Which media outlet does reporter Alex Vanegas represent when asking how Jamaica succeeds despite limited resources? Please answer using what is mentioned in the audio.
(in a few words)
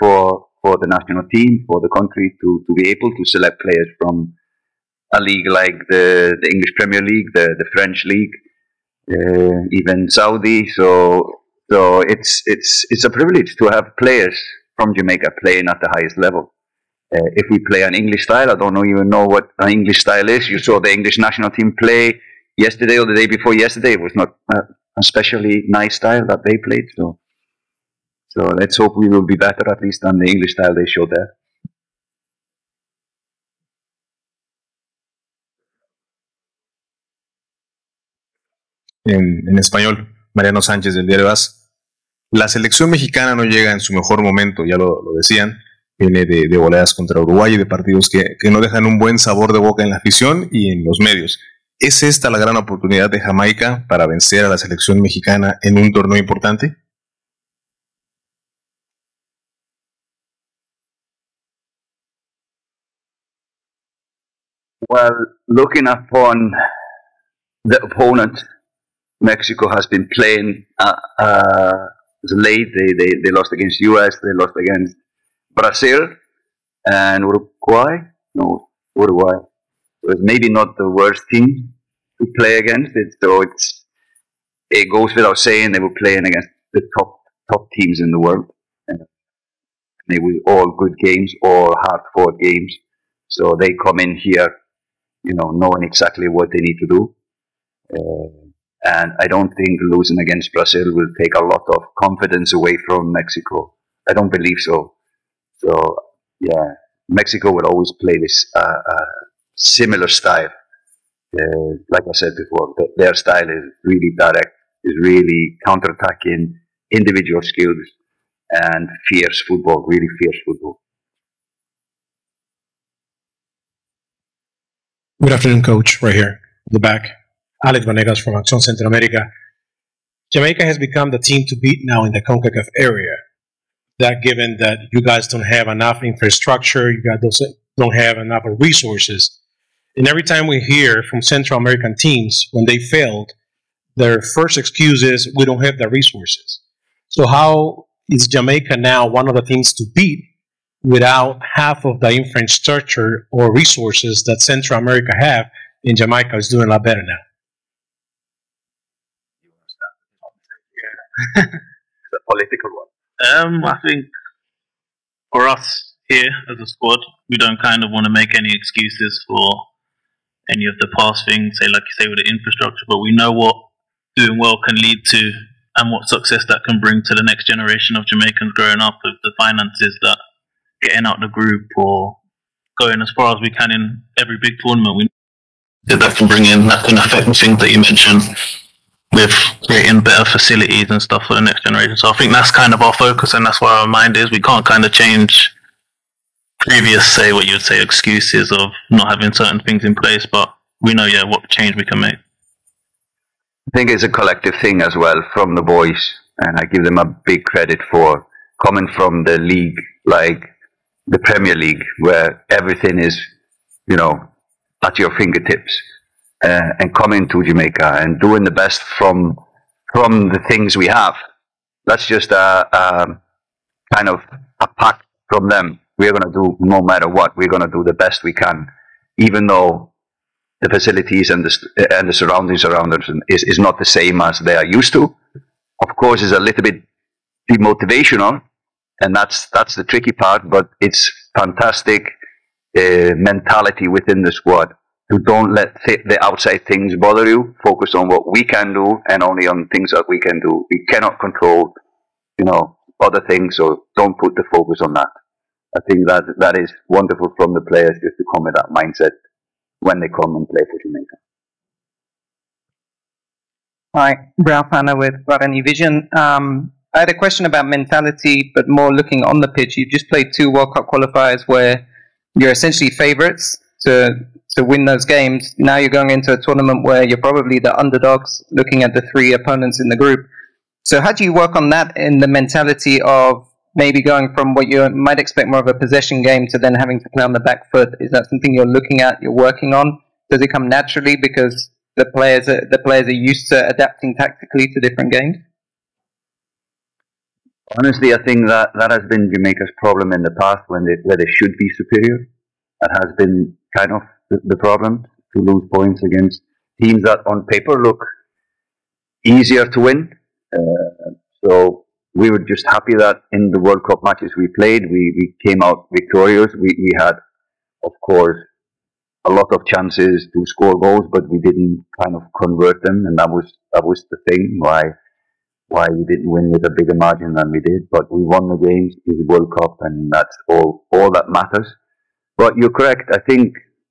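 Action Central America.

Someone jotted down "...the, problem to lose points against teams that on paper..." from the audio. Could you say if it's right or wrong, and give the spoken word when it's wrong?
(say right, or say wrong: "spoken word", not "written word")
right.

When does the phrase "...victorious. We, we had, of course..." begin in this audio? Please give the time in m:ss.
5:15.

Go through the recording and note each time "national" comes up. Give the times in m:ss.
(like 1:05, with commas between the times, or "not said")
0:00, 0:21.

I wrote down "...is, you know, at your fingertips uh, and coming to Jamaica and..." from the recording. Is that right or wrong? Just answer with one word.
right.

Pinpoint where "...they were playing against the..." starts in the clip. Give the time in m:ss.
1:25.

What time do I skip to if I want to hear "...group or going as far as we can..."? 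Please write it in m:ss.
3:01.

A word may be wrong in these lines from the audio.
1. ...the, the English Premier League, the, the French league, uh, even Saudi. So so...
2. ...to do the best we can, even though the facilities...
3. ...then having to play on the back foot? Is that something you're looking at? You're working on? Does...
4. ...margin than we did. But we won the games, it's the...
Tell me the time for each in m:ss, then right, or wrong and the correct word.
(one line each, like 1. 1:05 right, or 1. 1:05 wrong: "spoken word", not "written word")
1. 0:05 right
2. 3:47 right
3. 4:46 right
4. 5:26 right.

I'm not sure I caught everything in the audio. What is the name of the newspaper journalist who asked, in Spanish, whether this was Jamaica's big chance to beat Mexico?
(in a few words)
Mariano Sánchez.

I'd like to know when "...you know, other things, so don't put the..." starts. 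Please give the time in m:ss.
4:12.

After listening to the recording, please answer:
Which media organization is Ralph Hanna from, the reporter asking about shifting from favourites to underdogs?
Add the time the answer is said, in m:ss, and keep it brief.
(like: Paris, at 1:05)
Guarani Vision, at 4:25.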